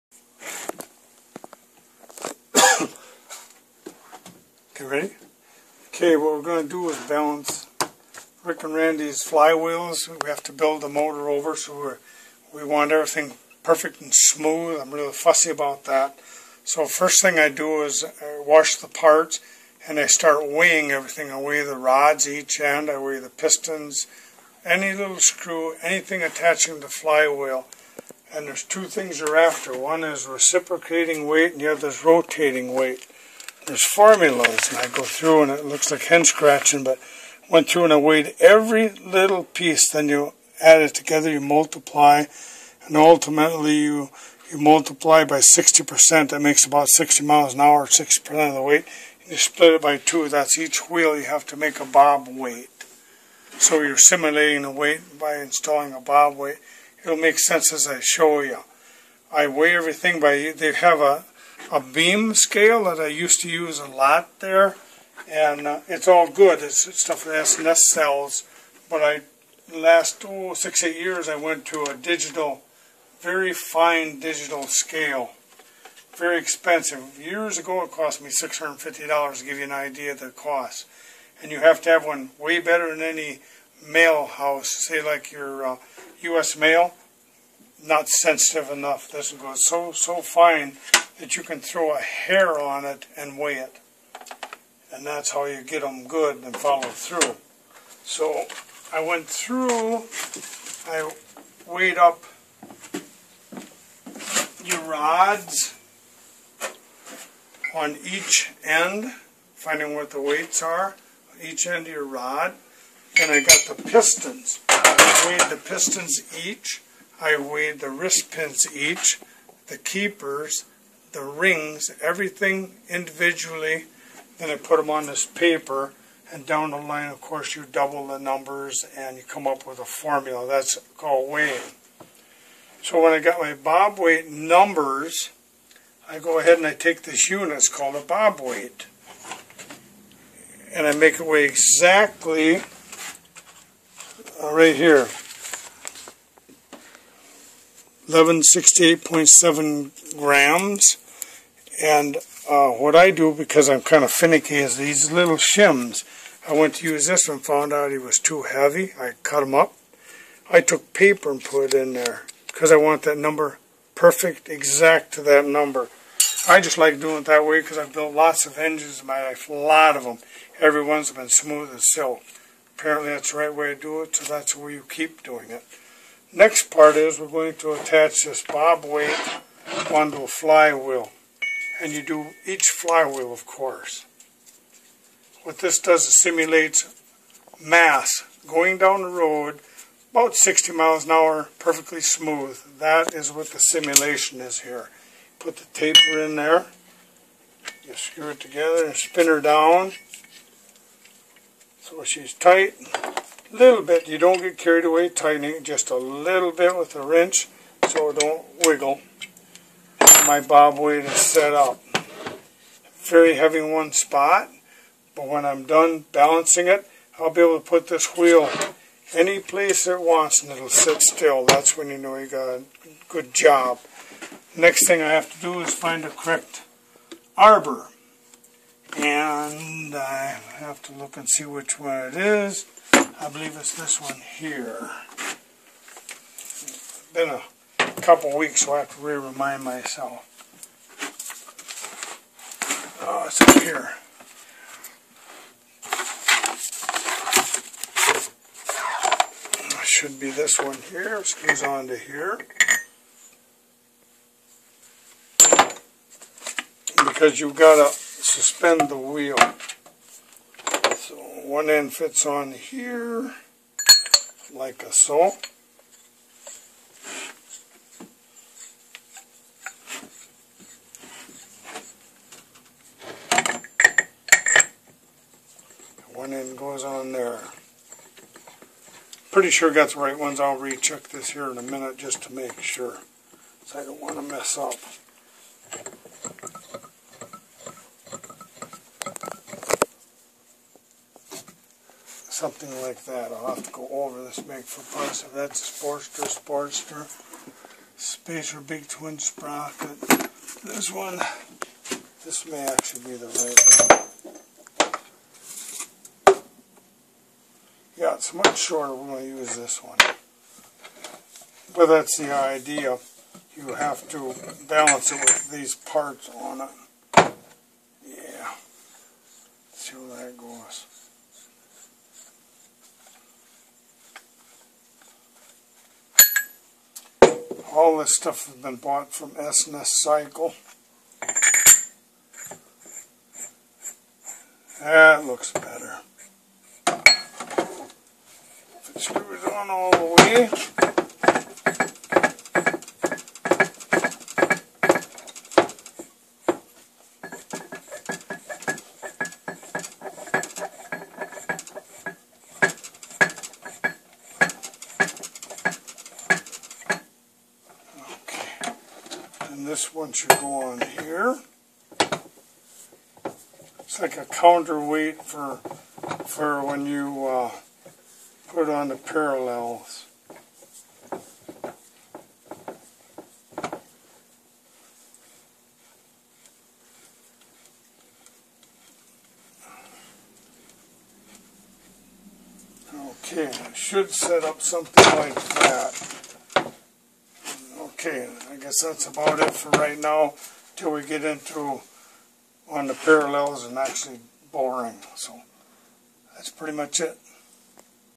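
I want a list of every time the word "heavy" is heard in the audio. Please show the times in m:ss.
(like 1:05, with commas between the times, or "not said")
2:38, 3:33.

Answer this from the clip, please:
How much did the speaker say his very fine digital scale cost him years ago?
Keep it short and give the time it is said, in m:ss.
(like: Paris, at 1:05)
$650, at 1:18.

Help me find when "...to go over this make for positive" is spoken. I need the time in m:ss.
4:53.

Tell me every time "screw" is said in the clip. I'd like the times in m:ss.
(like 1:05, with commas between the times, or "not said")
0:25, 3:17, 4:11, 5:39.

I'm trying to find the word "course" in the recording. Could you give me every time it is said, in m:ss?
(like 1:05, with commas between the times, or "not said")
2:07, 3:03.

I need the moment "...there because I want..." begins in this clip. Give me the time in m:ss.
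2:41.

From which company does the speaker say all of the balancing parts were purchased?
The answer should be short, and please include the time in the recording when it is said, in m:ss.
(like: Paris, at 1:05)
S&S Cycle, at 5:29.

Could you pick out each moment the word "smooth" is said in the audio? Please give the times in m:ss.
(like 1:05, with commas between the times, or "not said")
0:14, 2:51, 3:12.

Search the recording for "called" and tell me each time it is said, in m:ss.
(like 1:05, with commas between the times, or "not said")
2:10, 2:17.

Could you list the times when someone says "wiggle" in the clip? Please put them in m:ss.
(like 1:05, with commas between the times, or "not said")
3:28.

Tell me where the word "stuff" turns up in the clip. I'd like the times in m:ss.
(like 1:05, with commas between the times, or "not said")
1:07, 5:28.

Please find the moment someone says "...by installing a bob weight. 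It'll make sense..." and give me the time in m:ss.
0:55.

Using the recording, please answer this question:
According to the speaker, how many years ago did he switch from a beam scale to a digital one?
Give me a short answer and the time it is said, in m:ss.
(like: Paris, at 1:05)
6 to 8 years, at 1:10.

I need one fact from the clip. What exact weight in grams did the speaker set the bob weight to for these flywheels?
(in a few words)
1168.7 grams.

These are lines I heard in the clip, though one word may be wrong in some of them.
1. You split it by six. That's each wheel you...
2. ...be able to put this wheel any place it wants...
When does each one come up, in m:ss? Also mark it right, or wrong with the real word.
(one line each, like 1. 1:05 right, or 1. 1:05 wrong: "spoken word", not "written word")
1. 0:49 wrong: "two", not "six"
2. 3:37 right.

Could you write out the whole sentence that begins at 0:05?
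Okay, what we're going to do is balance Rick and Randy's flywheels.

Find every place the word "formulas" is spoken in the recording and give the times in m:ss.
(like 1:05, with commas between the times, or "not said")
0:33, 2:09.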